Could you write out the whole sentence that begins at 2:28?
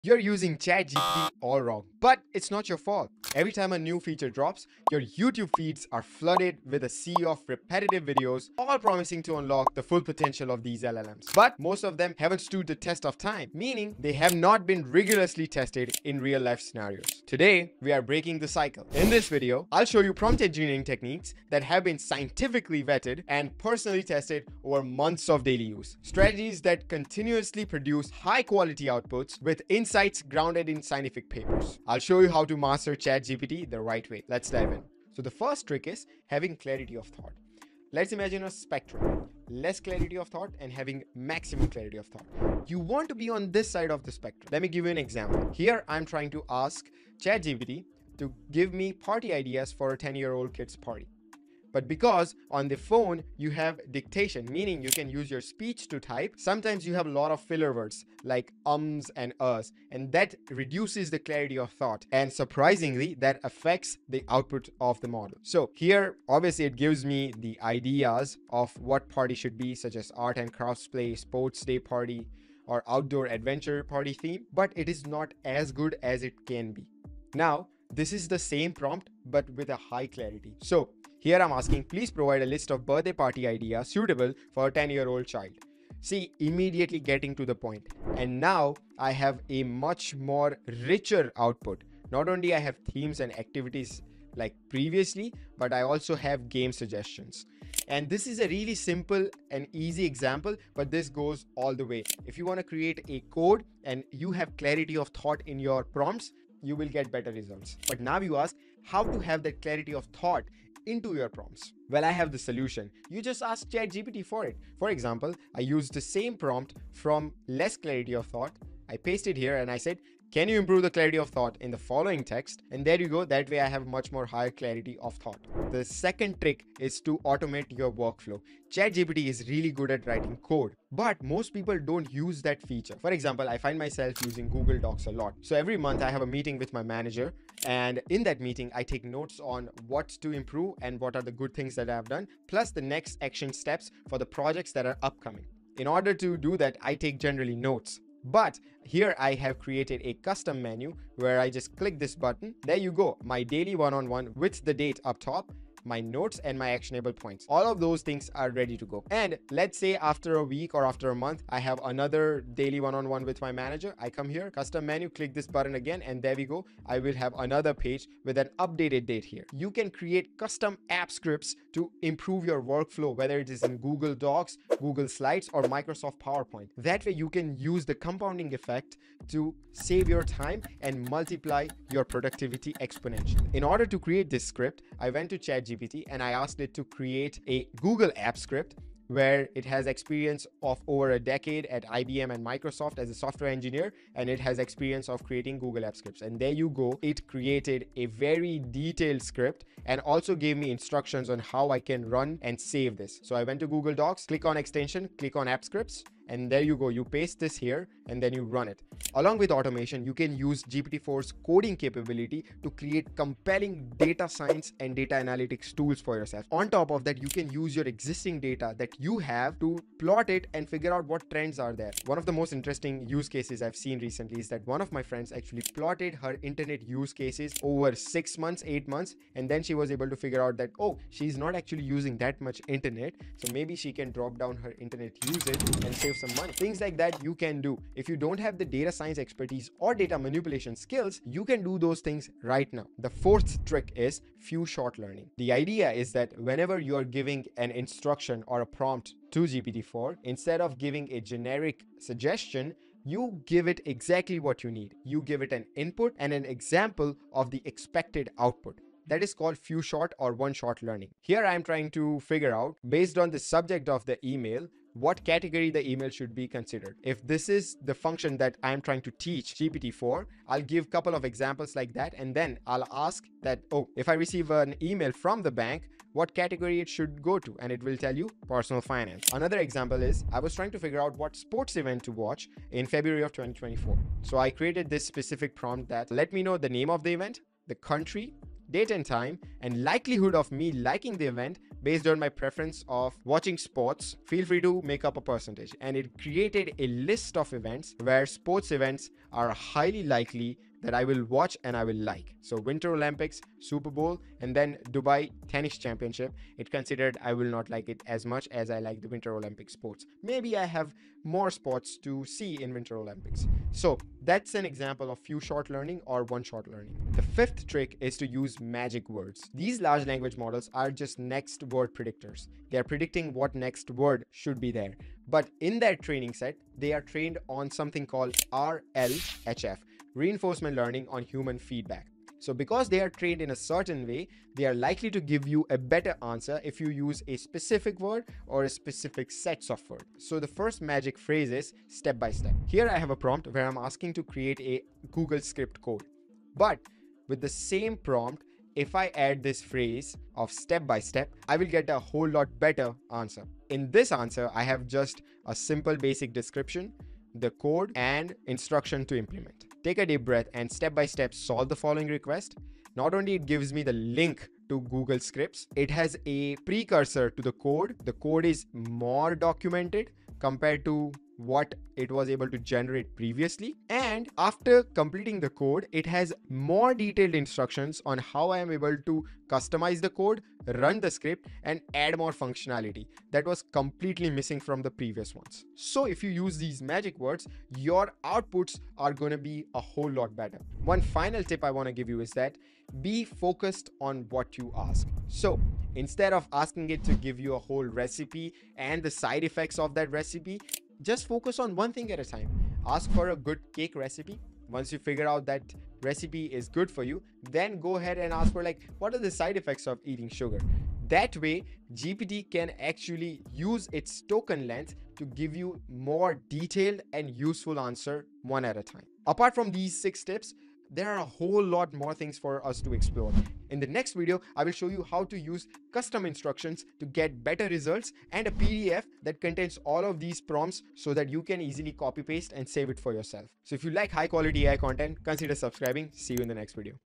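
But here I have created a custom menu where I just click this button.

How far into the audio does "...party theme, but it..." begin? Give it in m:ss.
1:13.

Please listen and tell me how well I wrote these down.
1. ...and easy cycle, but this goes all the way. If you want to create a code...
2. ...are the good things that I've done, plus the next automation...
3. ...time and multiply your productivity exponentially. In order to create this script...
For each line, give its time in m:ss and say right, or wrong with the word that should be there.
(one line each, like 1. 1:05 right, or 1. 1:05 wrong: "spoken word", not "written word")
1. 1:39 wrong: "example", not "cycle"
2. 2:21 wrong: "action", not "automation"
3. 3:00 right.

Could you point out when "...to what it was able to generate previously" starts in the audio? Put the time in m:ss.
6:10.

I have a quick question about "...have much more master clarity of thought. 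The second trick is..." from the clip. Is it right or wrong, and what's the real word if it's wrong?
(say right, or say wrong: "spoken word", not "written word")
wrong: "higher", not "master".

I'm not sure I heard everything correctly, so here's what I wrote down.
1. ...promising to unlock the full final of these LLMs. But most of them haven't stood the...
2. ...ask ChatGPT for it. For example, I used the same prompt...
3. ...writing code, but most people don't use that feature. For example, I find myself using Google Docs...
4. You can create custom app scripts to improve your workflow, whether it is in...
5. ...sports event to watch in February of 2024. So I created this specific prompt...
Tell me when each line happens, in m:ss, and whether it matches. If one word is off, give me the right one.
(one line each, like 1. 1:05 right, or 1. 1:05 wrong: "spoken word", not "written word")
1. 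0:08 wrong: "potential", not "final"
2. 1:53 right
3. 2:10 right
4. 2:49 right
5. 4:41 right.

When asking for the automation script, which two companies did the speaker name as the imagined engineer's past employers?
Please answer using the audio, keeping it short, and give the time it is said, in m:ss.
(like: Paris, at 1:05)
IBM and Microsoft, at 3:11.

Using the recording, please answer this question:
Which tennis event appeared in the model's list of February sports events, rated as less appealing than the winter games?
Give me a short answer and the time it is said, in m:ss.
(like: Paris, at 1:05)
Dubai Tennis Championship, at 5:04.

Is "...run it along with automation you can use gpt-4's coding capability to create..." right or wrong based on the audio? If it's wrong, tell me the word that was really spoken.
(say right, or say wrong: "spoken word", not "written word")
right.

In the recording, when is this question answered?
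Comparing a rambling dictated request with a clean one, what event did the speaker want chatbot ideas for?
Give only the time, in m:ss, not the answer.
0:49.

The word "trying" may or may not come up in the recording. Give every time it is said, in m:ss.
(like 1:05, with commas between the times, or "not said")
0:46, 4:21, 4:28, 4:40.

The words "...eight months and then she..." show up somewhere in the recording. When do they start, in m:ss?
3:48.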